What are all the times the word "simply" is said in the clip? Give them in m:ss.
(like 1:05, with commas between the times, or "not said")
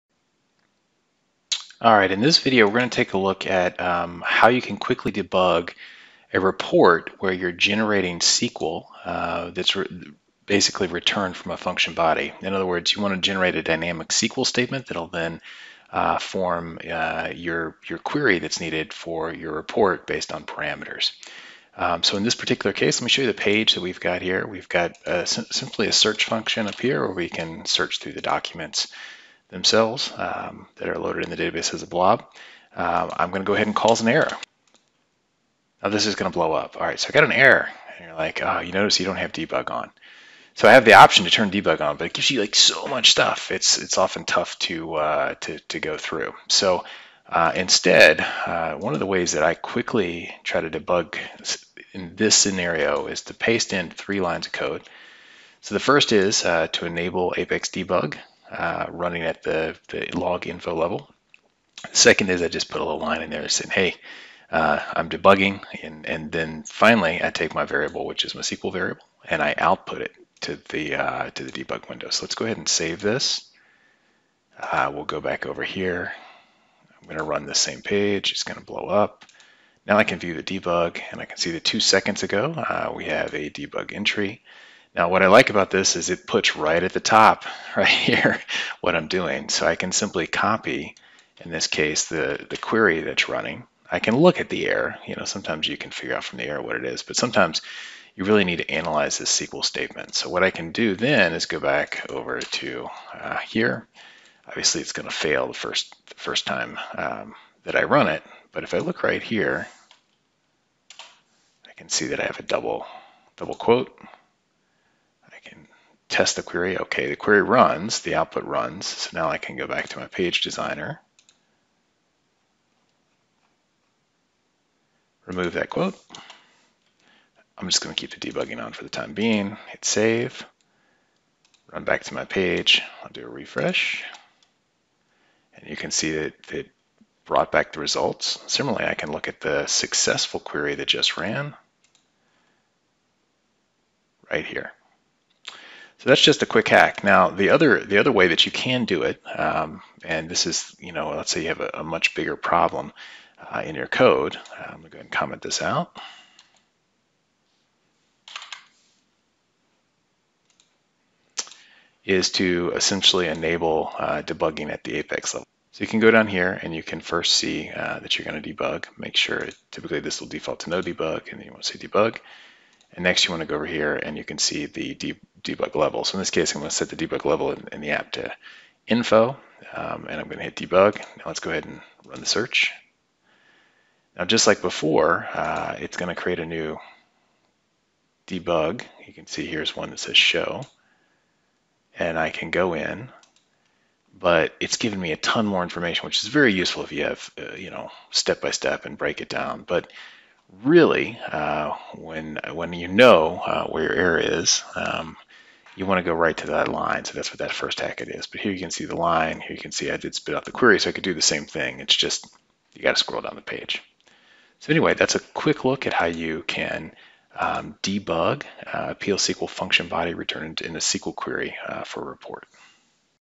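0:25, 1:29.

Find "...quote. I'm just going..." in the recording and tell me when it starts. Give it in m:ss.
2:05.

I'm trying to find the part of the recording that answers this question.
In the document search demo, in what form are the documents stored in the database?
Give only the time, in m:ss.
0:31.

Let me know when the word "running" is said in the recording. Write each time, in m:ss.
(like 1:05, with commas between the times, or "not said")
0:58, 1:33.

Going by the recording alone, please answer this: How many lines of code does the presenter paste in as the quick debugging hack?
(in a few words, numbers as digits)
3.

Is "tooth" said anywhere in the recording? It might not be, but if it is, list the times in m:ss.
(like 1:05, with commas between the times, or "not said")
not said.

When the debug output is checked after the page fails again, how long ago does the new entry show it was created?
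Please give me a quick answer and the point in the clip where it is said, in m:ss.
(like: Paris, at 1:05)
2 seconds ago, at 1:21.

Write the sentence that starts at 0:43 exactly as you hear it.
It's it's often tough to uh, to to go through.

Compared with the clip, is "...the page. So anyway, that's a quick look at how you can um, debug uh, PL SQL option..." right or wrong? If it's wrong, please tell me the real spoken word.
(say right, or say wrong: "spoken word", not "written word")
wrong: "function", not "option".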